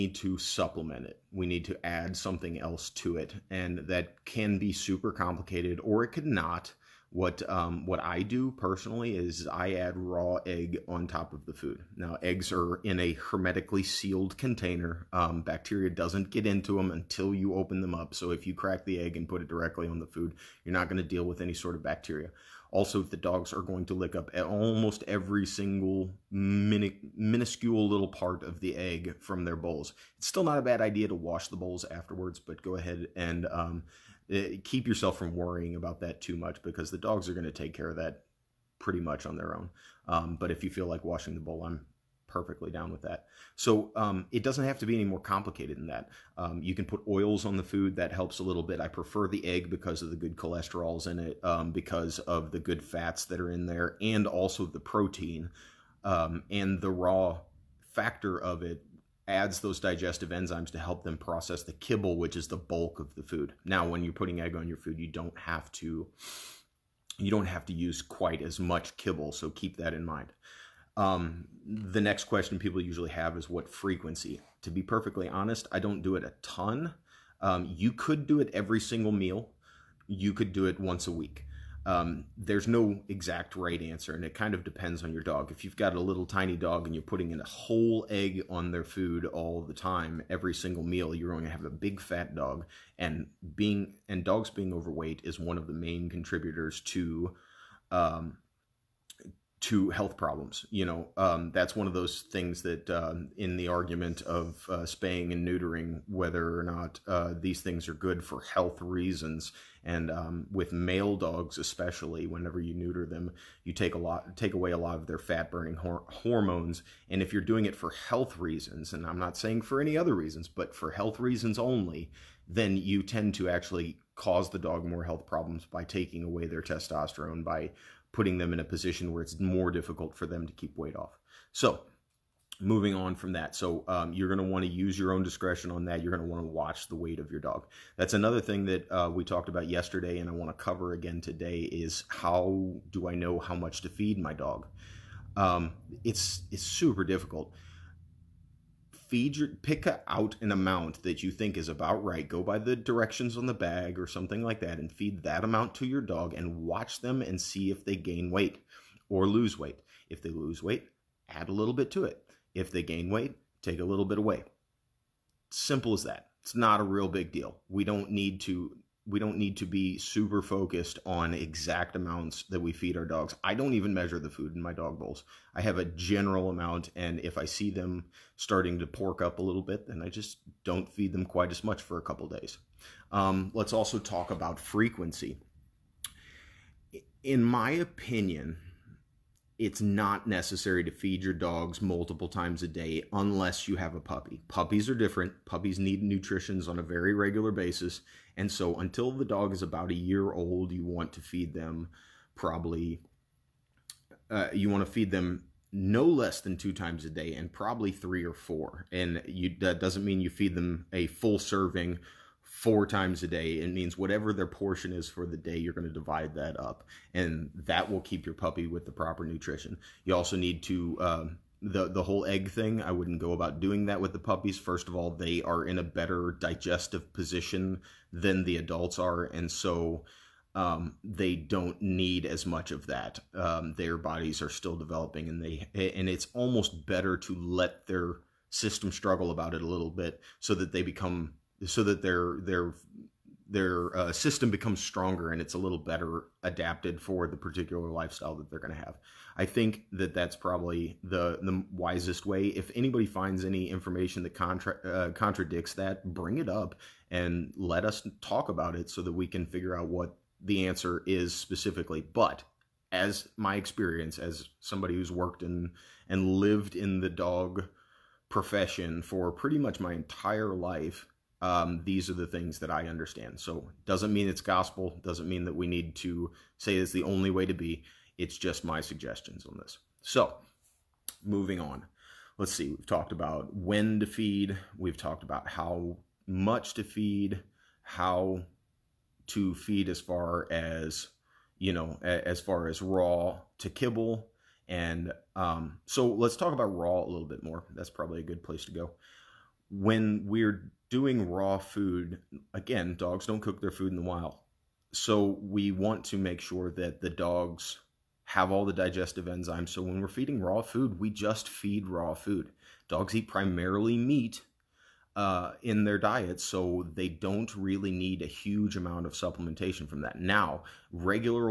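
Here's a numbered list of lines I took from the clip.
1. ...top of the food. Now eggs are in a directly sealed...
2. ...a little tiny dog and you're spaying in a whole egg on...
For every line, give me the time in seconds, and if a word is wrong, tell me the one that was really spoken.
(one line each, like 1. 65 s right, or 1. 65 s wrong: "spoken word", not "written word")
1. 11 s wrong: "hermetically", not "directly"
2. 85 s wrong: "putting", not "spaying".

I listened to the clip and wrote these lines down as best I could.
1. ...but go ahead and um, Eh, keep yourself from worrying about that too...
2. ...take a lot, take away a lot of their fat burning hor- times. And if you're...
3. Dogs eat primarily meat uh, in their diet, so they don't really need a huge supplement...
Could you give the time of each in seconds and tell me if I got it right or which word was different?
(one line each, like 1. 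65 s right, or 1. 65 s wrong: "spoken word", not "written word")
1. 32 s right
2. 113 s wrong: "hormones", not "times"
3. 312 s wrong: "amount", not "supplement".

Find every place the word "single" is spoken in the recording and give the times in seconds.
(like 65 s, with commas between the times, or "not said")
25 s, 78 s, 90 s.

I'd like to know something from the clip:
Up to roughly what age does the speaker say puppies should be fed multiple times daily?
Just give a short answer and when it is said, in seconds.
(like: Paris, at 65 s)
a year old, at 199 s.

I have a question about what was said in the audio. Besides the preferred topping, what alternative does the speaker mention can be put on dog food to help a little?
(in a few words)
oils.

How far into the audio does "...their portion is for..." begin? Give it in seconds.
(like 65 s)
214 s.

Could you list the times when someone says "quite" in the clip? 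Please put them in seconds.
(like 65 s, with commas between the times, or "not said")
68 s, 181 s.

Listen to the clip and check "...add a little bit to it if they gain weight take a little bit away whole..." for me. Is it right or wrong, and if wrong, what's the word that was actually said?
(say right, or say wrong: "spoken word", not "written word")
wrong: "simple", not "whole".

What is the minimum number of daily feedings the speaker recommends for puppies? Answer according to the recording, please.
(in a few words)
2.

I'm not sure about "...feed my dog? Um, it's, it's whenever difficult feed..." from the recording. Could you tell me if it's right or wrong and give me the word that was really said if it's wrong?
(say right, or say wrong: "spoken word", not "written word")
wrong: "super", not "whenever".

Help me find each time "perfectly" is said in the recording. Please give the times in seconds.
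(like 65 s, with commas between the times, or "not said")
42 s, 74 s.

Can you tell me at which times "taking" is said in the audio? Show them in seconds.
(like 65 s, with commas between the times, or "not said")
125 s.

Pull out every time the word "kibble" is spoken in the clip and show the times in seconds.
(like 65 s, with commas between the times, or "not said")
61 s, 68 s, 293 s.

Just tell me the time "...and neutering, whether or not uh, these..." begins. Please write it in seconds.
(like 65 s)
105 s.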